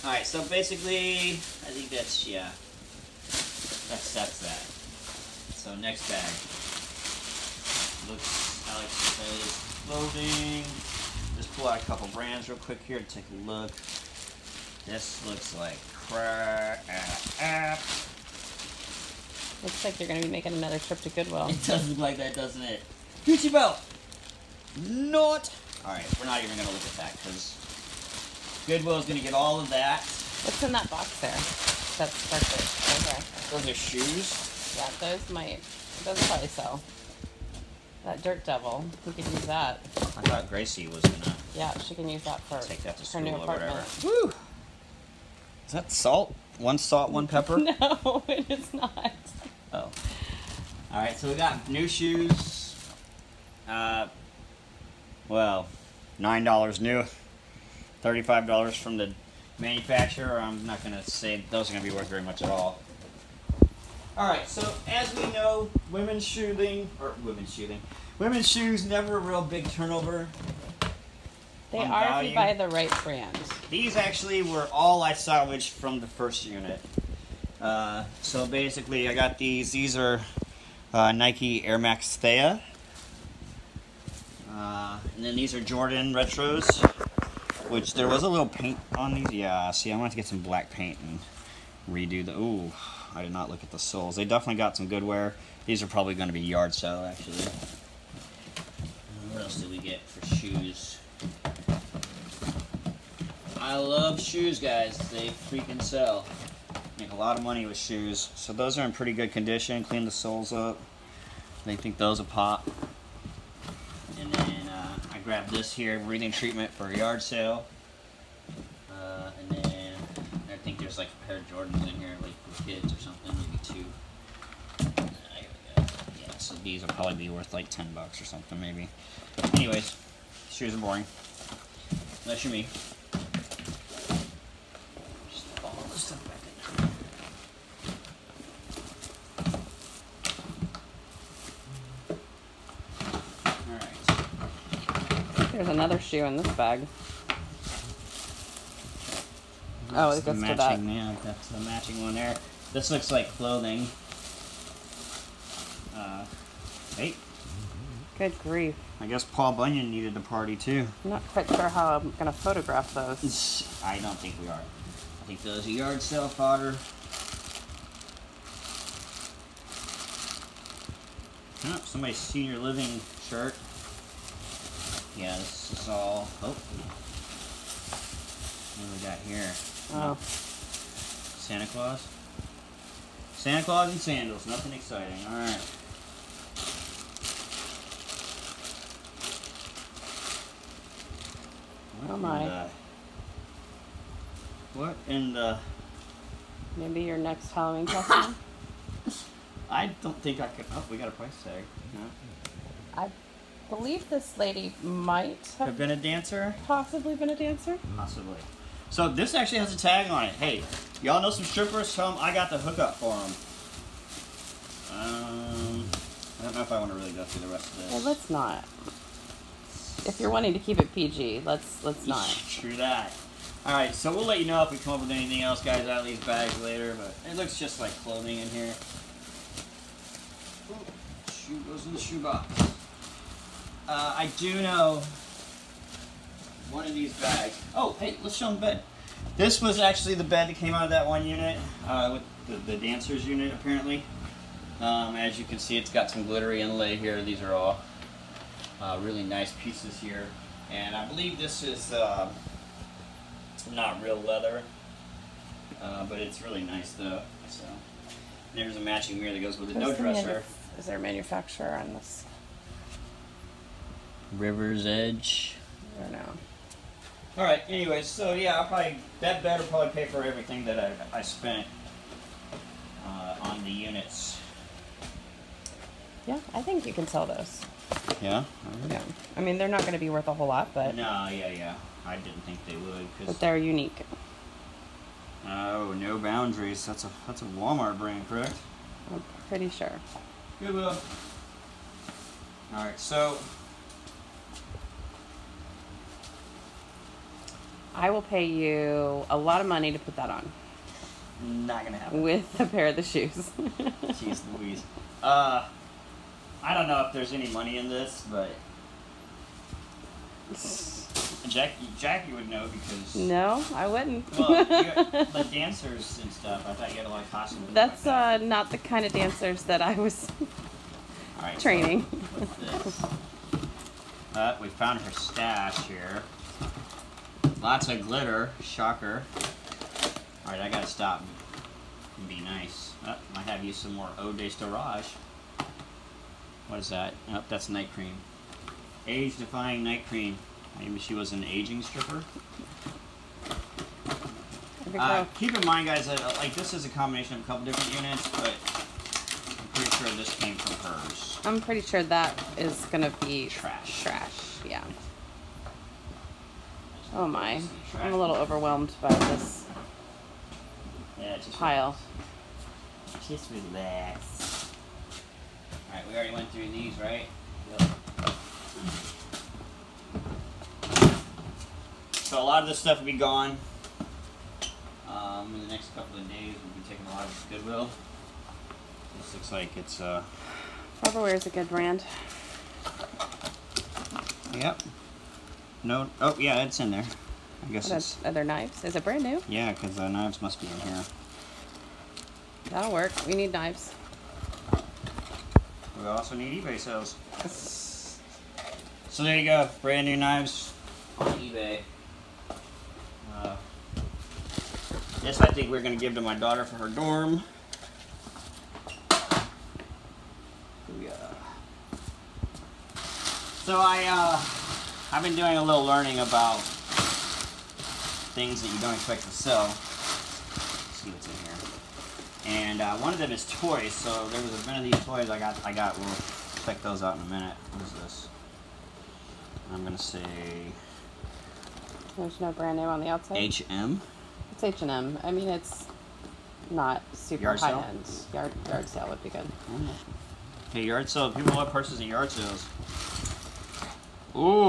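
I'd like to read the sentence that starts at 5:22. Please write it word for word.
So, uh, we found her stash here.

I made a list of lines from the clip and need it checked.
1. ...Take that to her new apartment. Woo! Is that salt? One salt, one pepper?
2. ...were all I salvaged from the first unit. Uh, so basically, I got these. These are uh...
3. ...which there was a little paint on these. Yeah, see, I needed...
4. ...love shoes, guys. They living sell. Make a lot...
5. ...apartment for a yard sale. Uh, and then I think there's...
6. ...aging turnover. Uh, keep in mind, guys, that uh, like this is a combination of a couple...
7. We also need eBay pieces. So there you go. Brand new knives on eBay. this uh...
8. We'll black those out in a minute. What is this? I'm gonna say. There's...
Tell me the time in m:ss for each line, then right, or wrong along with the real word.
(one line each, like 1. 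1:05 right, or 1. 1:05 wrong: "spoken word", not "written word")
1. 0:42 right
2. 1:14 right
3. 1:27 wrong: "wanted", not "needed"
4. 1:43 wrong: "freaking", not "living"
5. 1:56 wrong: "treatment", not "apartment"
6. 5:41 wrong: "stripper", not "turnover"
7. 6:36 wrong: "sales", not "pieces"
8. 7:06 wrong: "check", not "black".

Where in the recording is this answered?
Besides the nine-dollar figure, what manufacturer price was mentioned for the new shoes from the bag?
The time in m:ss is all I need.
0:58.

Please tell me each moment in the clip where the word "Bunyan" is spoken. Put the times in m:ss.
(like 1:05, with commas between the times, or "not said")
2:39.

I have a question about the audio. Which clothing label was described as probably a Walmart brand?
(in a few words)
No Boundaries.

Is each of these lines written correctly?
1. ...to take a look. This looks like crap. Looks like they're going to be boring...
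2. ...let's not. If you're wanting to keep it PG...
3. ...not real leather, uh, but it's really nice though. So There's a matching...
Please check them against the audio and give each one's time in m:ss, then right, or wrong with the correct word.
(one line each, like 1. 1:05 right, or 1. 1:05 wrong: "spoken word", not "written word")
1. 0:12 wrong: "making", not "boring"
2. 3:38 right
3. 4:13 right.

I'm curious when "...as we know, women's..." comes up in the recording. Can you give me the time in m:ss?
1:04.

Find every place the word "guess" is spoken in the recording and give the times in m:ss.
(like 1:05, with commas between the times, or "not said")
2:39, 6:27.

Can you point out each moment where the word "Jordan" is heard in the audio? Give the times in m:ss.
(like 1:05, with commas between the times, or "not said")
1:25, 2:01.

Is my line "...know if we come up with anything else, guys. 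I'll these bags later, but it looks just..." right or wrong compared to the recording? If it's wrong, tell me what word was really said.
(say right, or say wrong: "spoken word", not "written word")
right.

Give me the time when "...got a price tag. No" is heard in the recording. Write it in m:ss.
3:20.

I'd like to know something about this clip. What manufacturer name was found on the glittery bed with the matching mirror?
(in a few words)
River's Edge.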